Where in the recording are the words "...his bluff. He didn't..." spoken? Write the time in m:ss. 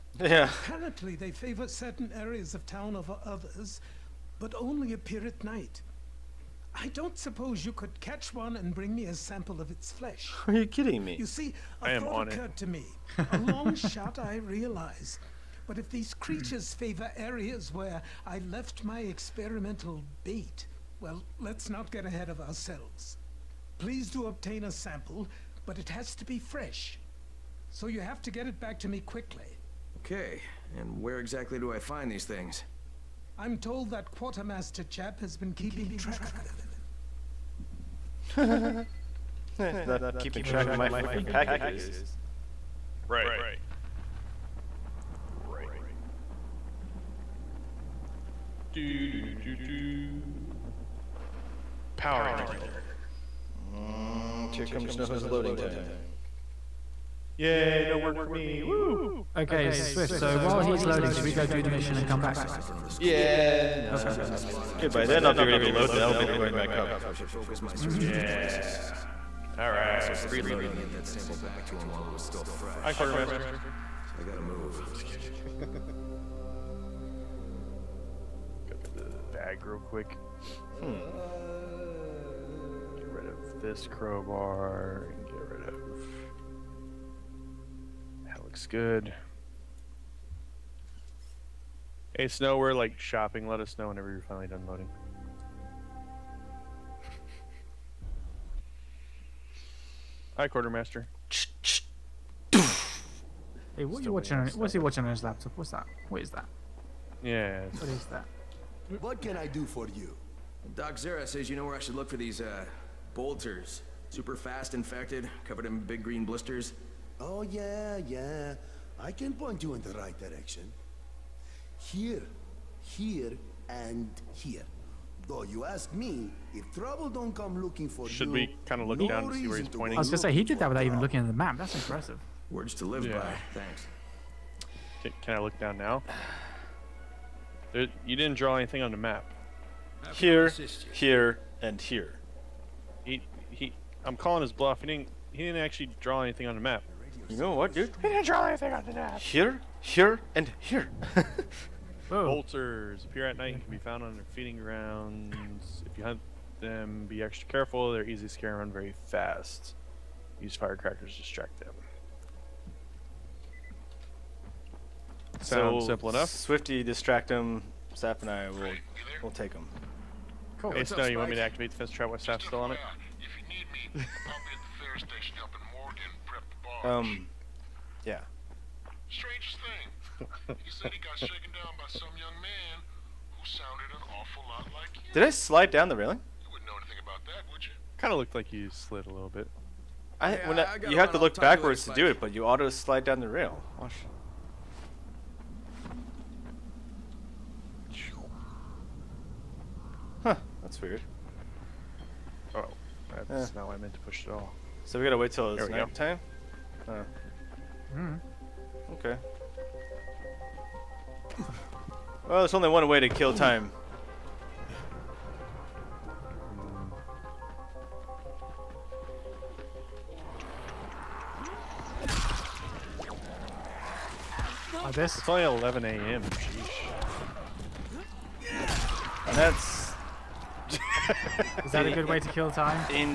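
2:24.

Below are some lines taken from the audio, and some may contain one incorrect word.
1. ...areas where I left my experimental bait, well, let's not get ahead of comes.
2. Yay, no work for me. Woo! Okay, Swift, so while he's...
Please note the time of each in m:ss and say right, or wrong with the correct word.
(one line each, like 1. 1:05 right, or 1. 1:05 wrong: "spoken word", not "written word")
1. 0:17 wrong: "ourselves", not "comes"
2. 0:57 right.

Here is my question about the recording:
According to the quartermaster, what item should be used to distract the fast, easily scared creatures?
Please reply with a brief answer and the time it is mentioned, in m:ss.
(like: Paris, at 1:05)
Firecrackers, at 2:40.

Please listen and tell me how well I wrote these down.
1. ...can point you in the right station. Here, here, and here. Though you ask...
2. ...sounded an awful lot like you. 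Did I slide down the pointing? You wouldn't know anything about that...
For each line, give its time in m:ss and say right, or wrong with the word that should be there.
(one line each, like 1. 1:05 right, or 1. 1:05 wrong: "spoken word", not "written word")
1. 1:59 wrong: "direction", not "station"
2. 3:03 wrong: "railing", not "pointing".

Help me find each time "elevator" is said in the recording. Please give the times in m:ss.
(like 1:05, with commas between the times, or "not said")
0:52, 1:06.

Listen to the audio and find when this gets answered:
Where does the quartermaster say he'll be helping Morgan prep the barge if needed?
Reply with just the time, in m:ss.
2:54.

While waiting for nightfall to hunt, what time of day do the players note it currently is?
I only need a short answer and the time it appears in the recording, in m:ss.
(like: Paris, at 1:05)
11 a.m., at 3:45.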